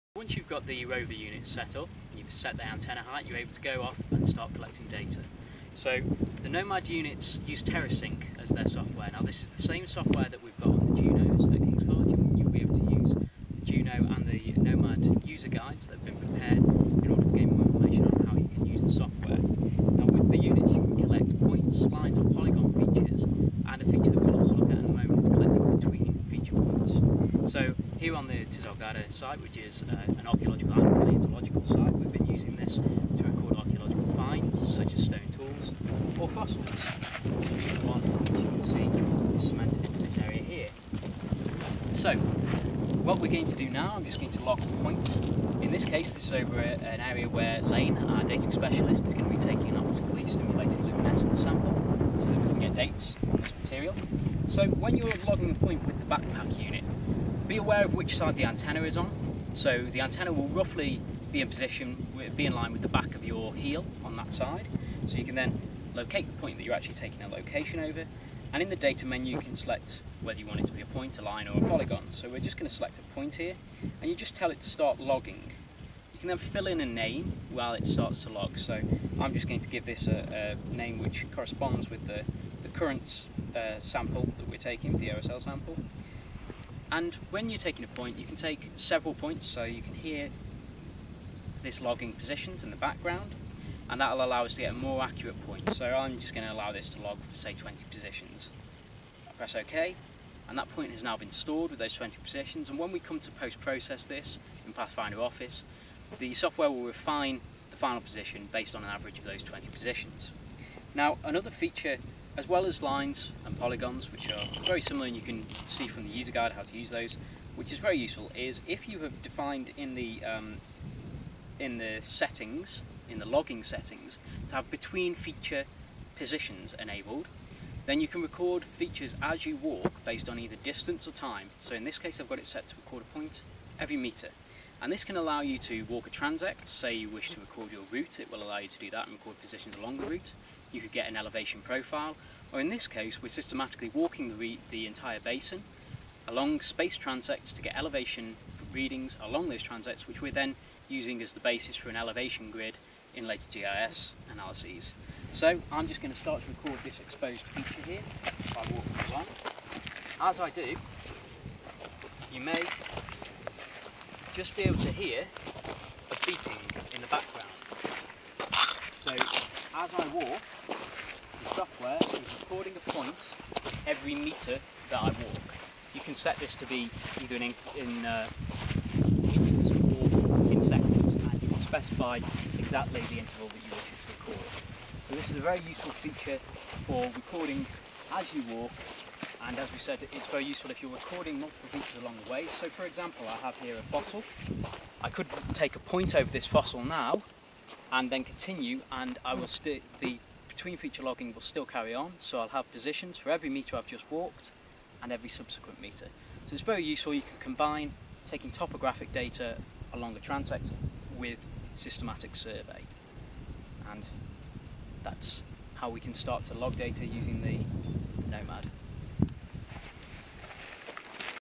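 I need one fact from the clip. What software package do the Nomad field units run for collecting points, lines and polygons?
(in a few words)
TerraSync.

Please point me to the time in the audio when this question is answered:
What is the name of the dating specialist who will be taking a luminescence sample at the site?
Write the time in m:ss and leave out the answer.
0:47.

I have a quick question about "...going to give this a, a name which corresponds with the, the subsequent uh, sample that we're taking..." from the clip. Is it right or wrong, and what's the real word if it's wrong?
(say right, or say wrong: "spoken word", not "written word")
wrong: "current", not "subsequent".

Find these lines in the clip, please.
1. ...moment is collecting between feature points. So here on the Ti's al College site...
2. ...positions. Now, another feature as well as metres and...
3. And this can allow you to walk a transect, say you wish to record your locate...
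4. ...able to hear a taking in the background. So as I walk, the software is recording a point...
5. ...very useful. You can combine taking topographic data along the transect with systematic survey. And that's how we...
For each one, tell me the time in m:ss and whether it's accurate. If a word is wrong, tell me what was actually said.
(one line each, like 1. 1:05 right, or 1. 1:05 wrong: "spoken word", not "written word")
1. 0:24 wrong: "Ghadah", not "College"
2. 1:49 wrong: "lines", not "metres"
3. 2:14 wrong: "route", not "locate"
4. 2:44 wrong: "beeping", not "taking"
5. 3:26 right.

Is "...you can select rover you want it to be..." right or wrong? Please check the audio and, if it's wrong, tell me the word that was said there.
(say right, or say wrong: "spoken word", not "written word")
wrong: "whether", not "rover".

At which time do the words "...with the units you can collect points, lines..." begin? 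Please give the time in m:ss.
0:20.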